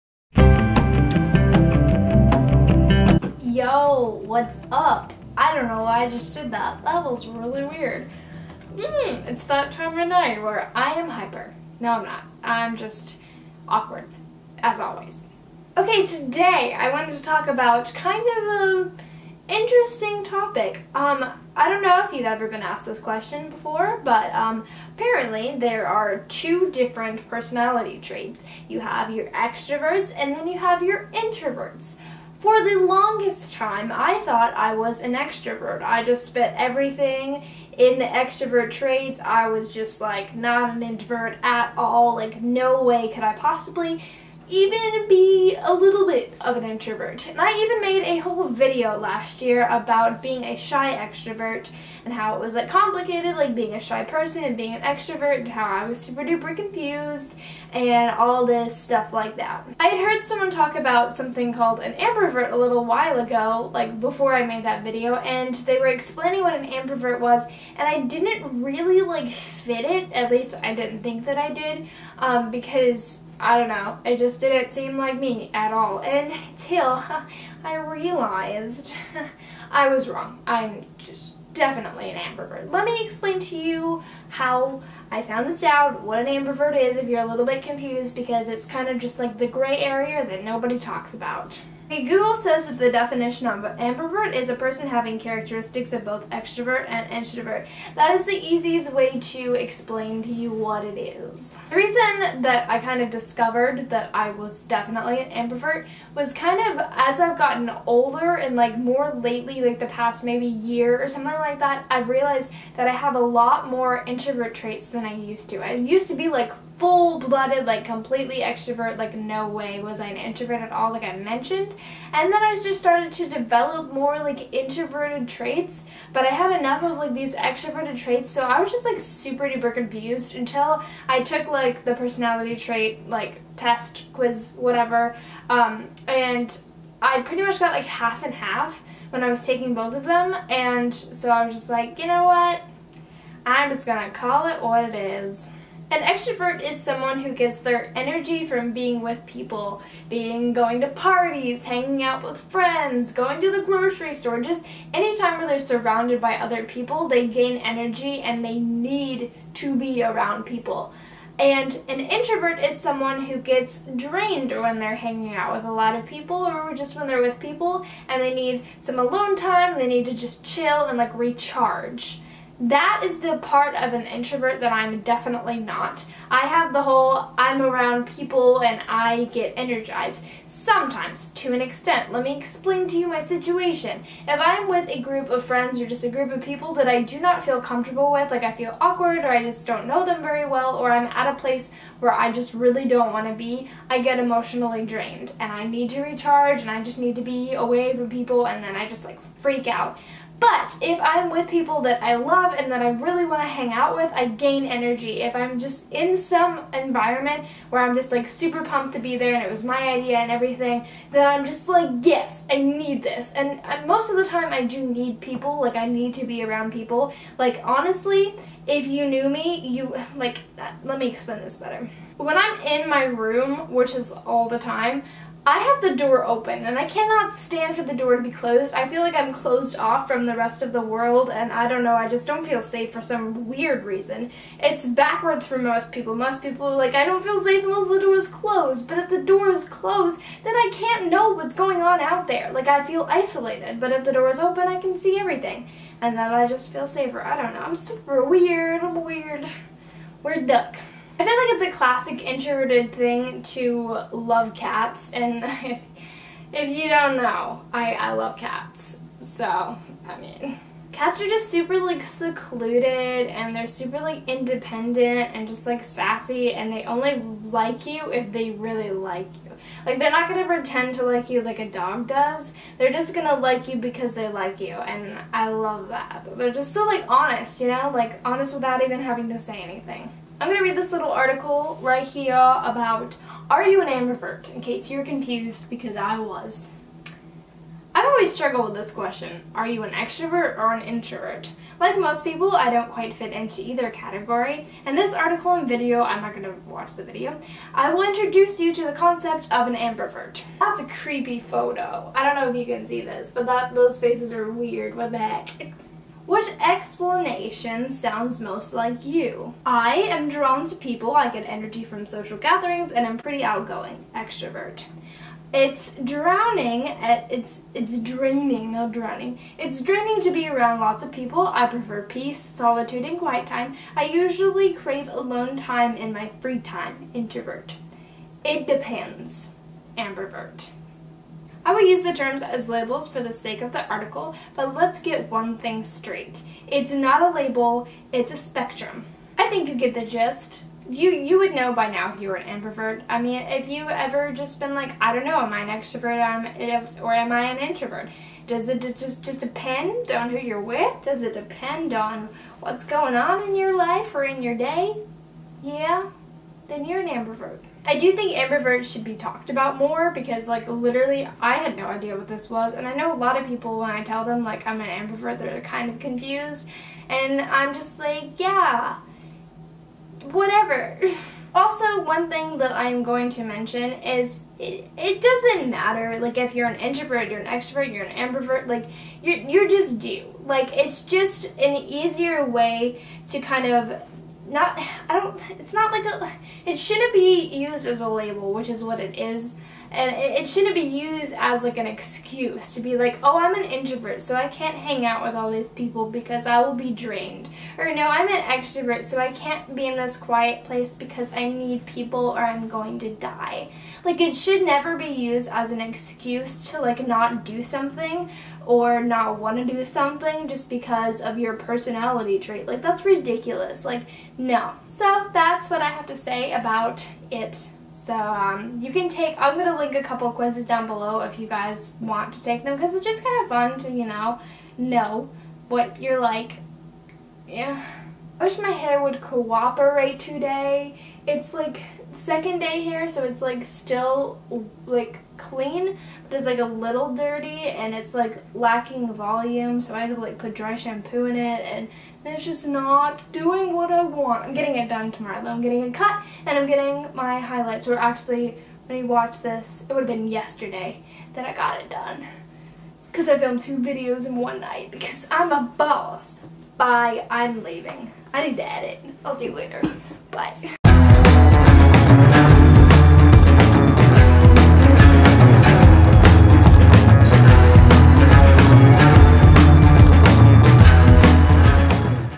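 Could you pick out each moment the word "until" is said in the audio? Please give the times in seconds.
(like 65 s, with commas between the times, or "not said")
75 s, 130 s.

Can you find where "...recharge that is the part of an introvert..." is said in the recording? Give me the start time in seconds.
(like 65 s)
171 s.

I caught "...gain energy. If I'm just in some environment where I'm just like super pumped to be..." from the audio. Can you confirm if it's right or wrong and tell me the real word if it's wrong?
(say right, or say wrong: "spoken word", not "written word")
right.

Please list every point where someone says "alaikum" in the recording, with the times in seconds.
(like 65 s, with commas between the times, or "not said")
not said.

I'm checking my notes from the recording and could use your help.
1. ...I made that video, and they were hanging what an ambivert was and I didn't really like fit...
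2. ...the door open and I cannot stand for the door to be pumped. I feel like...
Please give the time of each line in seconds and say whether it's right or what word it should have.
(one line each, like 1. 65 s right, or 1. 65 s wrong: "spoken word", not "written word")
1. 64 s wrong: "explaining", not "hanging"
2. 225 s wrong: "closed", not "pumped".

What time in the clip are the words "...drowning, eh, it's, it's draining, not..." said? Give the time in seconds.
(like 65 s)
316 s.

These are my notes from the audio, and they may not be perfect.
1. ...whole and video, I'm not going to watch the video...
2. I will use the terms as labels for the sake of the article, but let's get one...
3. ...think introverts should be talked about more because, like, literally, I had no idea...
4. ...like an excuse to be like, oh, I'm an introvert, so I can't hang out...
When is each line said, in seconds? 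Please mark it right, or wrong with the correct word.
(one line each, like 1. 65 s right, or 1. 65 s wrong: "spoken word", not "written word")
1. 295 s wrong: "article", not "whole"
2. 331 s right
3. 358 s wrong: "ambiverts", not "introverts"
4. 391 s right.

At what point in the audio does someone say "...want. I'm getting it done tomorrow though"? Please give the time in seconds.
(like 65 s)
444 s.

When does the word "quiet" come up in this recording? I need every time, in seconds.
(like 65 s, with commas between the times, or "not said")
323 s, 400 s.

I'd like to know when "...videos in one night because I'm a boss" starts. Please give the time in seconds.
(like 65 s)
453 s.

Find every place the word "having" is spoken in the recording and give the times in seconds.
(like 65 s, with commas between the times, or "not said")
94 s, 279 s.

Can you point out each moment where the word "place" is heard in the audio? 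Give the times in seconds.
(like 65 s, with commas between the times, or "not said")
191 s, 400 s.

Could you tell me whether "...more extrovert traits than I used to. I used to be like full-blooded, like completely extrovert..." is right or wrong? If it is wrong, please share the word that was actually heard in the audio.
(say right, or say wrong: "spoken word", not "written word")
wrong: "introvert", not "extrovert".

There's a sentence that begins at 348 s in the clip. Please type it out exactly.
Does it just, just depend on who you're with?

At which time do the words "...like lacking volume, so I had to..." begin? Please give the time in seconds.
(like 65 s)
438 s.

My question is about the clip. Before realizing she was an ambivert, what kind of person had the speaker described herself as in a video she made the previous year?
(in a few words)
shy extrovert.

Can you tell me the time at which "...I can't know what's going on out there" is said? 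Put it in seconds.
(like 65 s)
240 s.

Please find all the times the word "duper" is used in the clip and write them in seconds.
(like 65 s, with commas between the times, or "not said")
56 s, 129 s.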